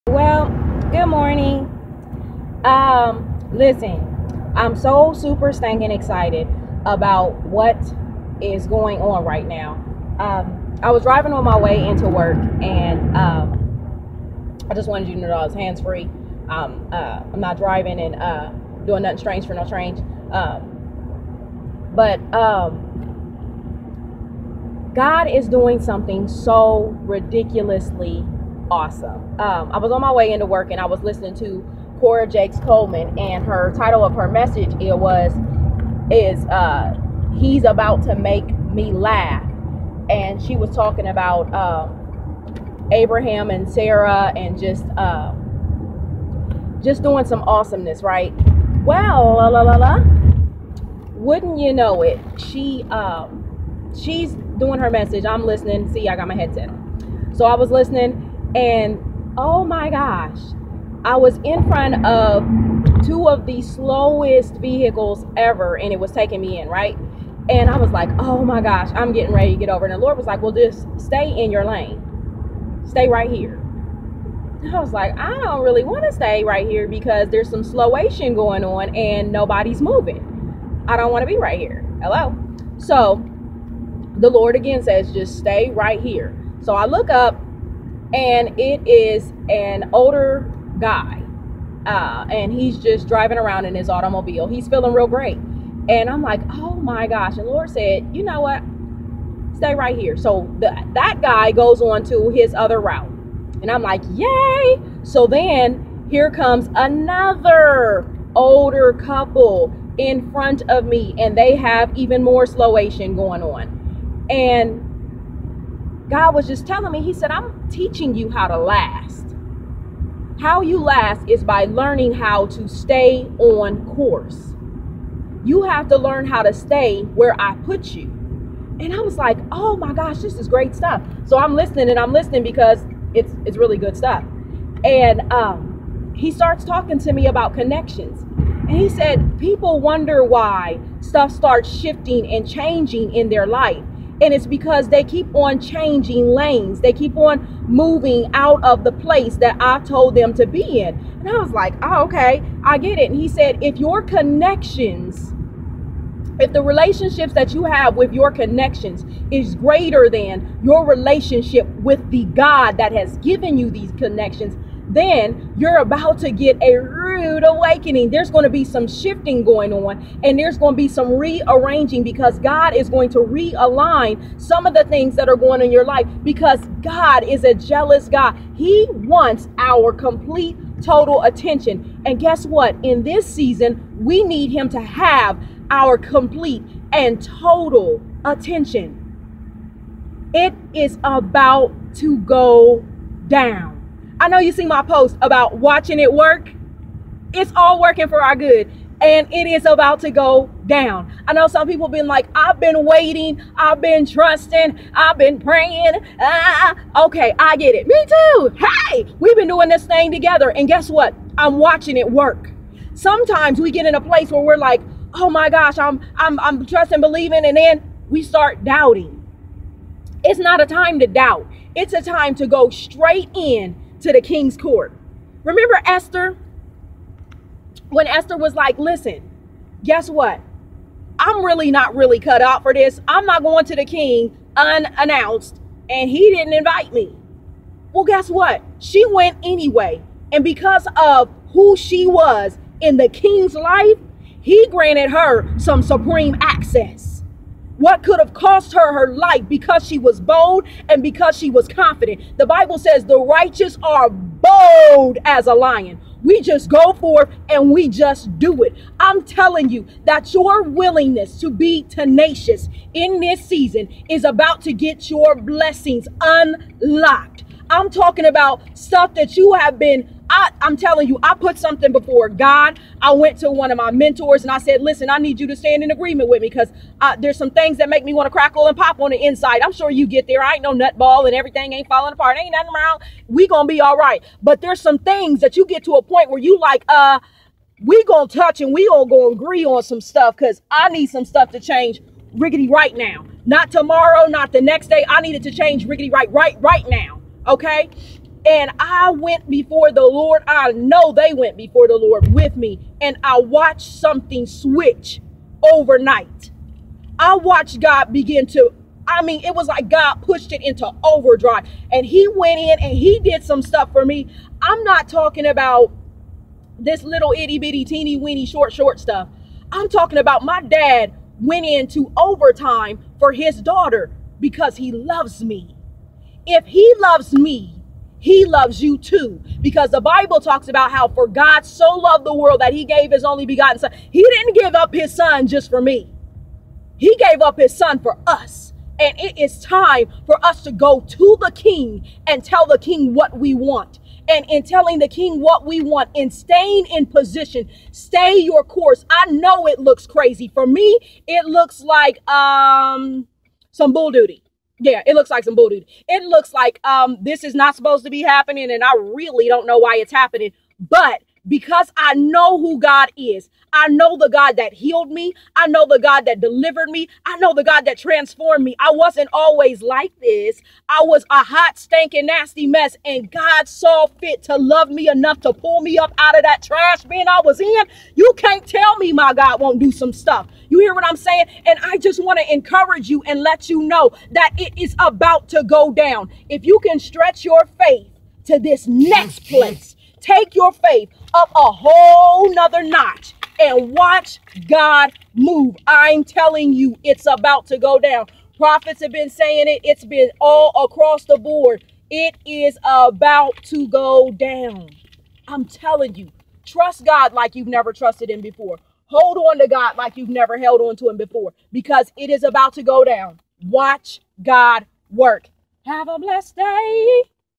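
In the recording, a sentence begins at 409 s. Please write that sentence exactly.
Hold on to God like you've never held on to Him before because it is about to go down.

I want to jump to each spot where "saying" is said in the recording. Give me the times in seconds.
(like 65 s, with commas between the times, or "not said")
381 s, 399 s.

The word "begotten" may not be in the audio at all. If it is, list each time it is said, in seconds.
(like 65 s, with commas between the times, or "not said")
333 s.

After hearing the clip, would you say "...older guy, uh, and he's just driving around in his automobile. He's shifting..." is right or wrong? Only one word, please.
wrong.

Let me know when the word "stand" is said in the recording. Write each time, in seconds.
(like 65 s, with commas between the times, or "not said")
275 s.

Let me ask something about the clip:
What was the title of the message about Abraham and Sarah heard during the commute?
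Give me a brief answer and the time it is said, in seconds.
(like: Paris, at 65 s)
He's about to make me laugh, at 37 s.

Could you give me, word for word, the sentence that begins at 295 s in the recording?
I needed to change riggedy right, right, right now.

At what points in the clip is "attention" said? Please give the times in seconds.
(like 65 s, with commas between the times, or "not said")
181 s, 188 s.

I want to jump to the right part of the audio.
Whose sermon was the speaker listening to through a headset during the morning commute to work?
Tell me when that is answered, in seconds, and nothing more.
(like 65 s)
31 s.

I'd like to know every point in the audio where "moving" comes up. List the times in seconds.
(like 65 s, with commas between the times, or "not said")
79 s, 147 s.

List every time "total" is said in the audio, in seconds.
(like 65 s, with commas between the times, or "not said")
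180 s, 187 s.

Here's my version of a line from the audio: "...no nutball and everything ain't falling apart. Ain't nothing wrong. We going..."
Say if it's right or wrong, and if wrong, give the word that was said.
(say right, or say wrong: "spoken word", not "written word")
right.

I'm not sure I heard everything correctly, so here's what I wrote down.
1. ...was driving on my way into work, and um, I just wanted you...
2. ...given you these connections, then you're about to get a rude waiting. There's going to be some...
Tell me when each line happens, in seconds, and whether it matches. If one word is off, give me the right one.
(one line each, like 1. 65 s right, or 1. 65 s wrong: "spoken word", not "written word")
1. 10 s right
2. 163 s wrong: "awakening", not "waiting".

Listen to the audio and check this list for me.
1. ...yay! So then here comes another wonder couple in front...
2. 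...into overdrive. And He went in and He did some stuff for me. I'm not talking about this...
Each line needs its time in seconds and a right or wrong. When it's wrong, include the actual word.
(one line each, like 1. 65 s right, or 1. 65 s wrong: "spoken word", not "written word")
1. 104 s wrong: "older", not "wonder"
2. 310 s right.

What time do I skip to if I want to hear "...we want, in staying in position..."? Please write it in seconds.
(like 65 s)
345 s.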